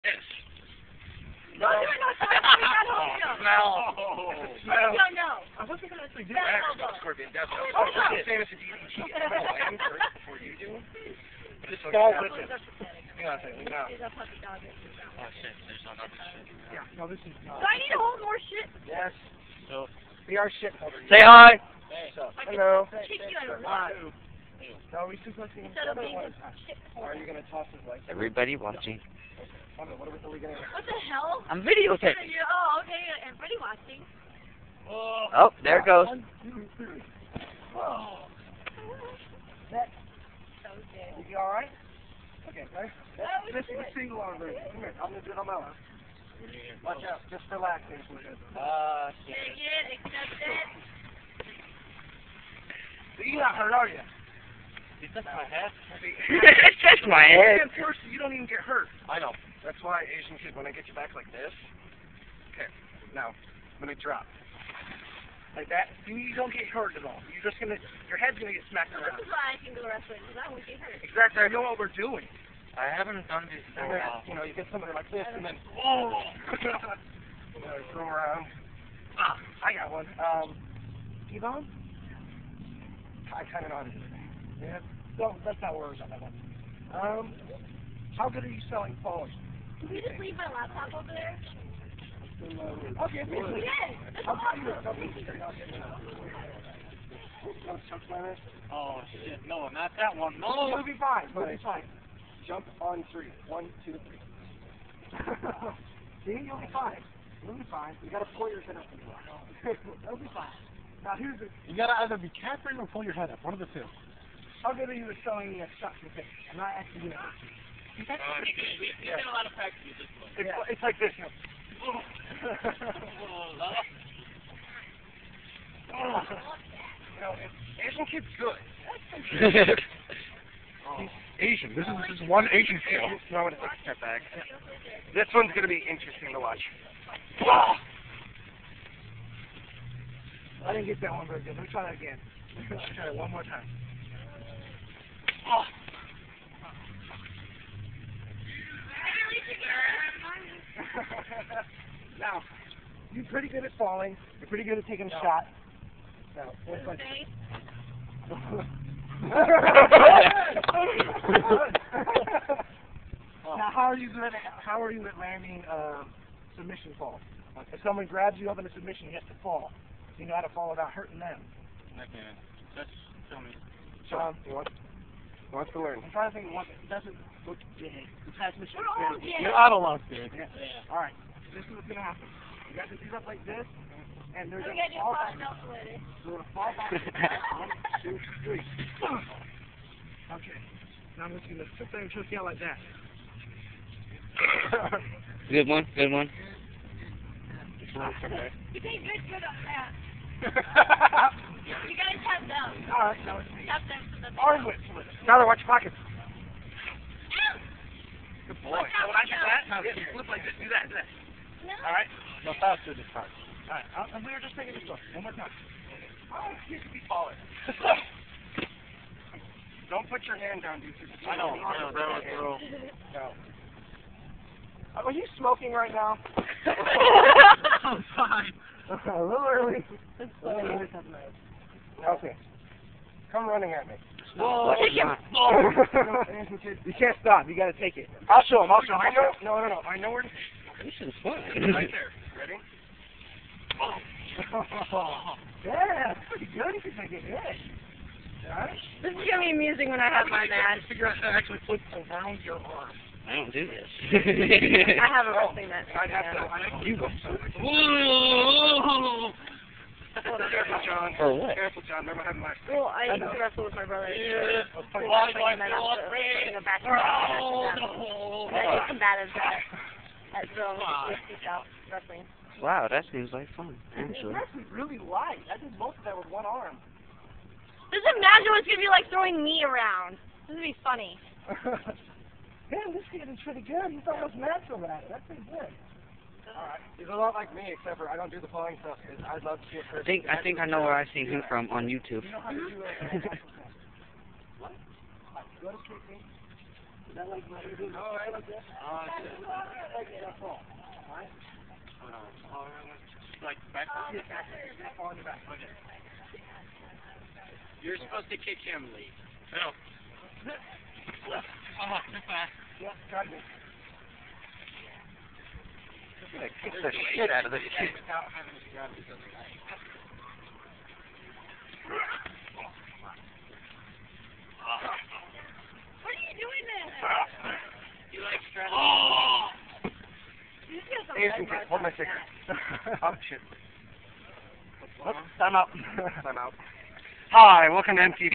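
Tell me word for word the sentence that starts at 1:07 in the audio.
You're just gonna, your head's gonna get smacked around.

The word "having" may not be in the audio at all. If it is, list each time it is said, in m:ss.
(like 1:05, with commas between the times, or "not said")
4:22, 5:18.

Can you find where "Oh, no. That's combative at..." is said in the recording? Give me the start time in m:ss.
4:27.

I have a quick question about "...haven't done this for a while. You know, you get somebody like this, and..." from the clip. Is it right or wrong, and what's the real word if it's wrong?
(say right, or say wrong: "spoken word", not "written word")
right.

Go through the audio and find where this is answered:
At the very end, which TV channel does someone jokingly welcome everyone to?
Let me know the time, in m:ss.
5:38.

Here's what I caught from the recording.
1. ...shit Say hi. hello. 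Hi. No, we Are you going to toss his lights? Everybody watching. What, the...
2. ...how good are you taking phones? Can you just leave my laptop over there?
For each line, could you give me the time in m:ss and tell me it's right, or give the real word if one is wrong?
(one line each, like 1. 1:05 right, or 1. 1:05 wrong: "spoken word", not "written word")
1. 0:20 right
2. 1:28 wrong: "selling", not "taking".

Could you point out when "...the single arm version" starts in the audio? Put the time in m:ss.
0:43.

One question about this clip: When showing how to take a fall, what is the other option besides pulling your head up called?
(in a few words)
Catherine.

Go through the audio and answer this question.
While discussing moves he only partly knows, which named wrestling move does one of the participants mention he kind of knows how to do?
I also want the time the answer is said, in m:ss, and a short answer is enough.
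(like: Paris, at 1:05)
T-bone, at 1:21.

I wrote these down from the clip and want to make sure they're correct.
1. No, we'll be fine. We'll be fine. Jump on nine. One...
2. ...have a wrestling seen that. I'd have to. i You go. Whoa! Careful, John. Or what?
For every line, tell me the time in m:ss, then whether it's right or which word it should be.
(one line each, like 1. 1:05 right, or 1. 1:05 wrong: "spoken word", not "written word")
1. 1:40 wrong: "three", not "nine"
2. 4:15 right.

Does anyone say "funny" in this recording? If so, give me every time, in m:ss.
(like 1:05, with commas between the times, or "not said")
4:40.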